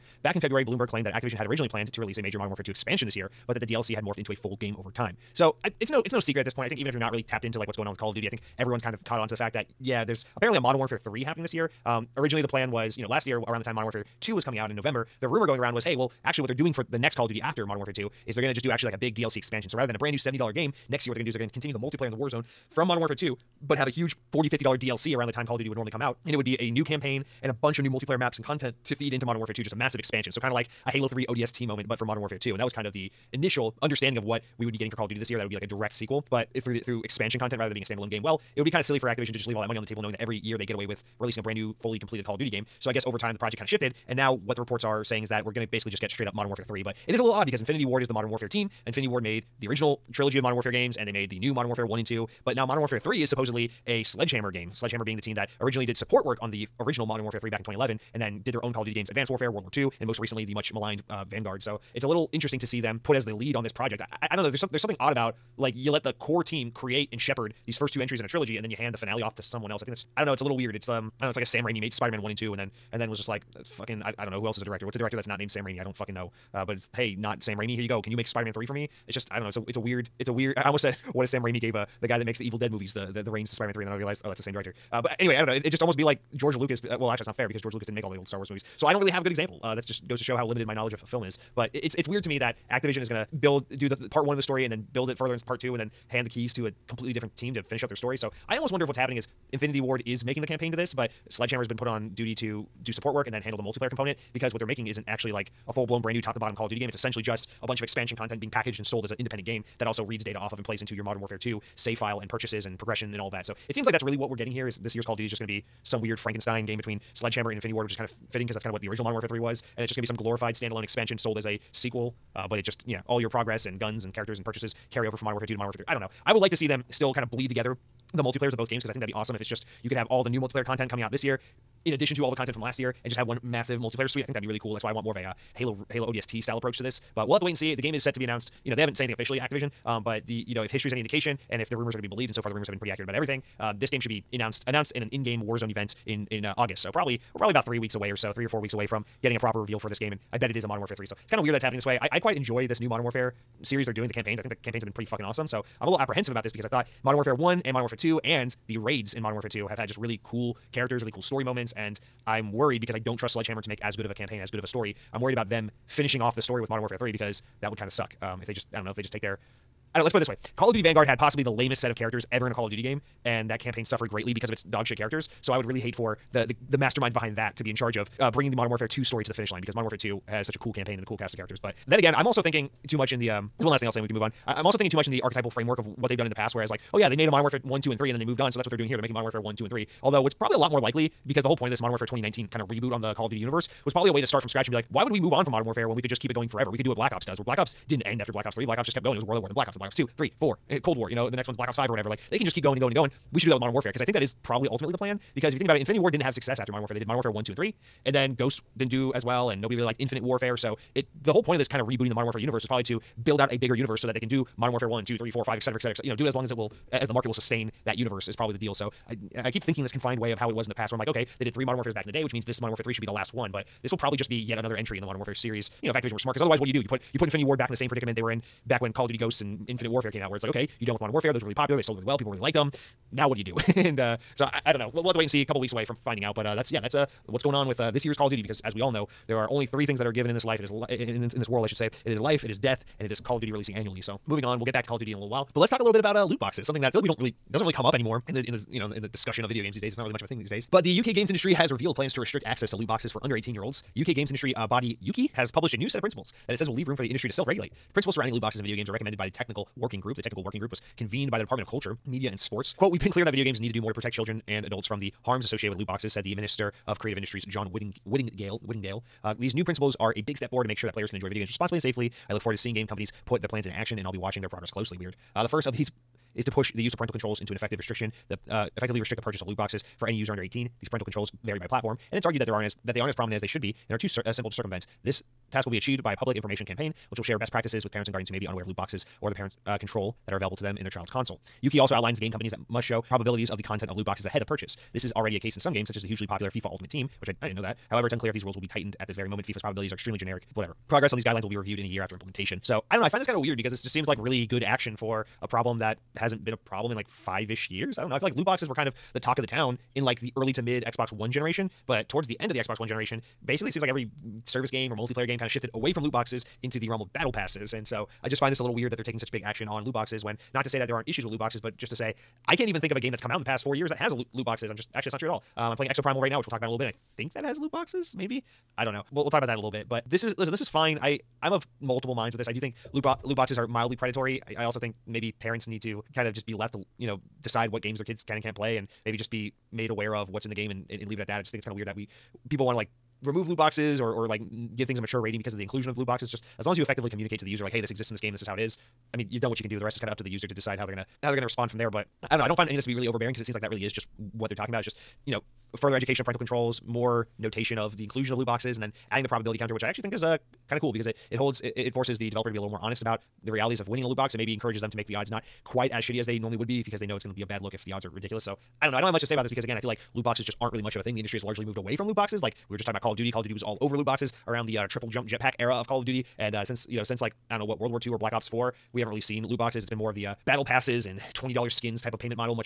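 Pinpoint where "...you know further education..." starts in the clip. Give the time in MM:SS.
05:55.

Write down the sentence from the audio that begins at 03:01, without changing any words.
But then again, I'm also thinking too much in the um there's one last thing I'll say and we can move on.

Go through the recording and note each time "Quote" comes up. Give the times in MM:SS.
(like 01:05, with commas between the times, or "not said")
04:22.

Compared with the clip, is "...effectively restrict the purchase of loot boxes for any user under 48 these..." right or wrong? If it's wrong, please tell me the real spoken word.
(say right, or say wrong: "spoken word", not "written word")
wrong: "18", not "48".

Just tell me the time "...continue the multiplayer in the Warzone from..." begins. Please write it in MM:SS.
00:21.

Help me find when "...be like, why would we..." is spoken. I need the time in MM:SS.
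03:14.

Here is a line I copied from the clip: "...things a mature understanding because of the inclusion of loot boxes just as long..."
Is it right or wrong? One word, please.
wrong.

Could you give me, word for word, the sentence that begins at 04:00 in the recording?
It is li- in, in, in this world, I should say.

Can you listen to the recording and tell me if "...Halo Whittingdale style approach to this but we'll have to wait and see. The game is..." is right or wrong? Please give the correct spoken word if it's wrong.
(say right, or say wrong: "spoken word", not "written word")
wrong: "ODST", not "Whittingdale".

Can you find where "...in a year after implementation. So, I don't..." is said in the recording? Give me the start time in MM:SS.
05:01.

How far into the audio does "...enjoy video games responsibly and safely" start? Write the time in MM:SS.
04:31.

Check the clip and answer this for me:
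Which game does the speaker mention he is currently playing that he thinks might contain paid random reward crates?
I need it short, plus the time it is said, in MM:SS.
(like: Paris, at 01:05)
Exoprimal, at 05:25.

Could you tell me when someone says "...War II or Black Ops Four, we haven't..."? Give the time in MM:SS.
06:17.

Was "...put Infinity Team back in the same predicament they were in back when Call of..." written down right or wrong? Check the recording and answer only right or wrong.
wrong.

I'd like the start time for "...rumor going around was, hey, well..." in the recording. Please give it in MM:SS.
00:15.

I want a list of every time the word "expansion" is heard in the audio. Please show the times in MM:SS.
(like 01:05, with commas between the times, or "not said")
00:02, 00:19, 00:29, 00:37, 01:47, 02:00.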